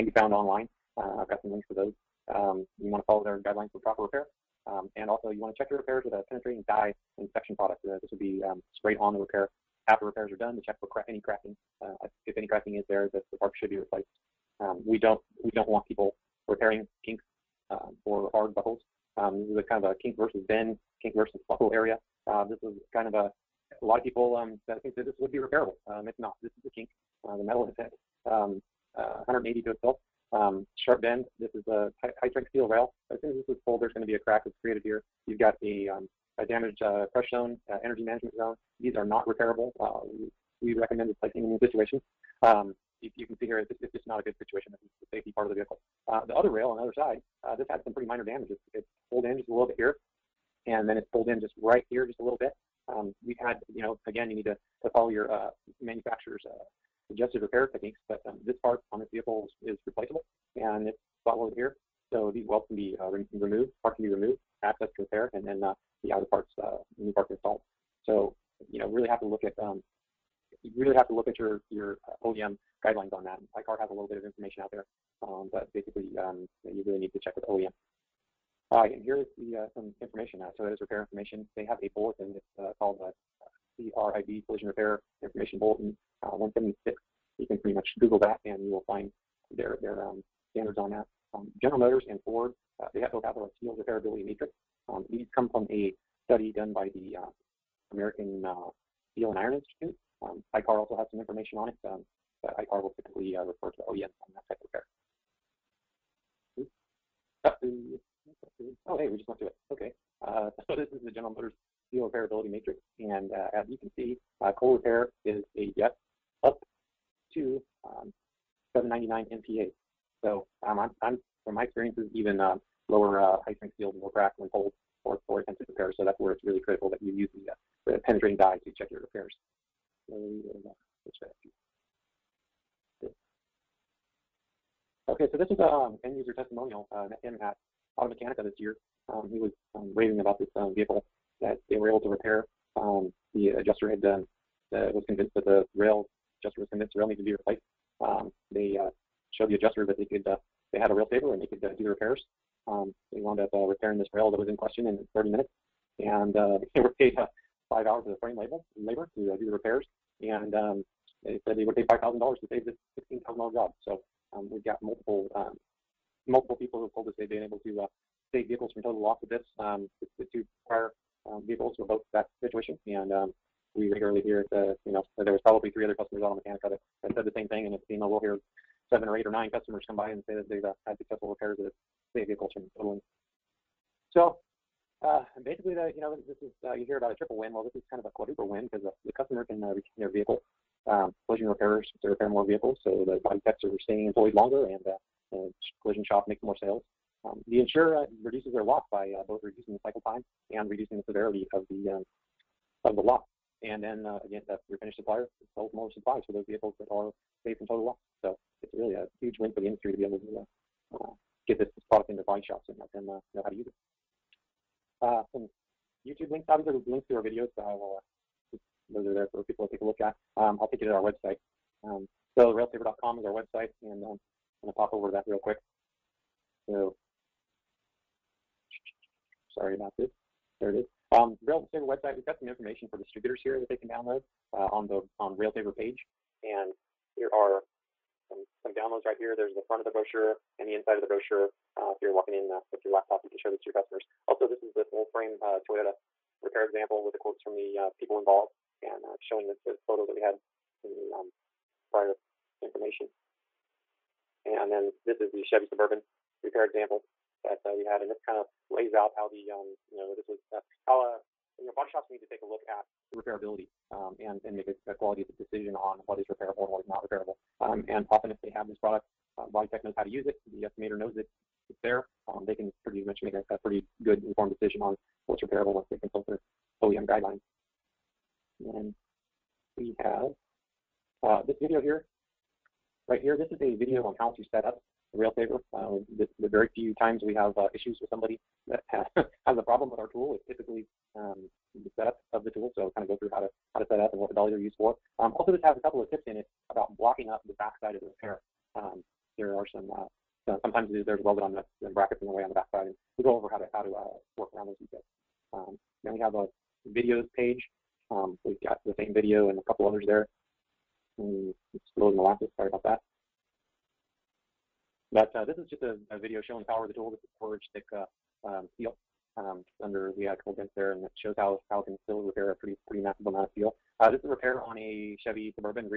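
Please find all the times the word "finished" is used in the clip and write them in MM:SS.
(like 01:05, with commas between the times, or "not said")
03:24.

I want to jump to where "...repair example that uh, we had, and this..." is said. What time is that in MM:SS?
04:16.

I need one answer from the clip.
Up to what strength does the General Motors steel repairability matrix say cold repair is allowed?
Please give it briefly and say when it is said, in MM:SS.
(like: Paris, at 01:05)
799 MPa, at 01:58.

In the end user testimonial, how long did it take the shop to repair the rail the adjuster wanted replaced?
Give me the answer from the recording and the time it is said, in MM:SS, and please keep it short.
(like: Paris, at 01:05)
30 minutes, at 02:35.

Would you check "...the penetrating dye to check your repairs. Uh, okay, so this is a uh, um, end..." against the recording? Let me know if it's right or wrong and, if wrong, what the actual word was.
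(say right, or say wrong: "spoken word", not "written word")
right.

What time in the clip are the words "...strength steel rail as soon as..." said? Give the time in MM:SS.
00:32.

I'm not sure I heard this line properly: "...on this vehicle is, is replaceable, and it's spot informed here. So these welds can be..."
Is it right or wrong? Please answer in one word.
wrong.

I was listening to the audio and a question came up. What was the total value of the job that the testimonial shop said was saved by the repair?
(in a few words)
$16,000.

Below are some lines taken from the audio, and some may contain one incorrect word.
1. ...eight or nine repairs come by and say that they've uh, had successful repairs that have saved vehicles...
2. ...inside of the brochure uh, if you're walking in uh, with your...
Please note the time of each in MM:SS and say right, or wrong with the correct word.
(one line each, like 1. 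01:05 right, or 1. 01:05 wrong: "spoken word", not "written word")
1. 02:59 wrong: "customers", not "repairs"
2. 04:00 right.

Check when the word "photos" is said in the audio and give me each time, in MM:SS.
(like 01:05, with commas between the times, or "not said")
04:09.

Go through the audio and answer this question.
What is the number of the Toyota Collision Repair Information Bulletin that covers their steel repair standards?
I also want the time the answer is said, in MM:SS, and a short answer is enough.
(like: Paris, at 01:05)
176, at 01:26.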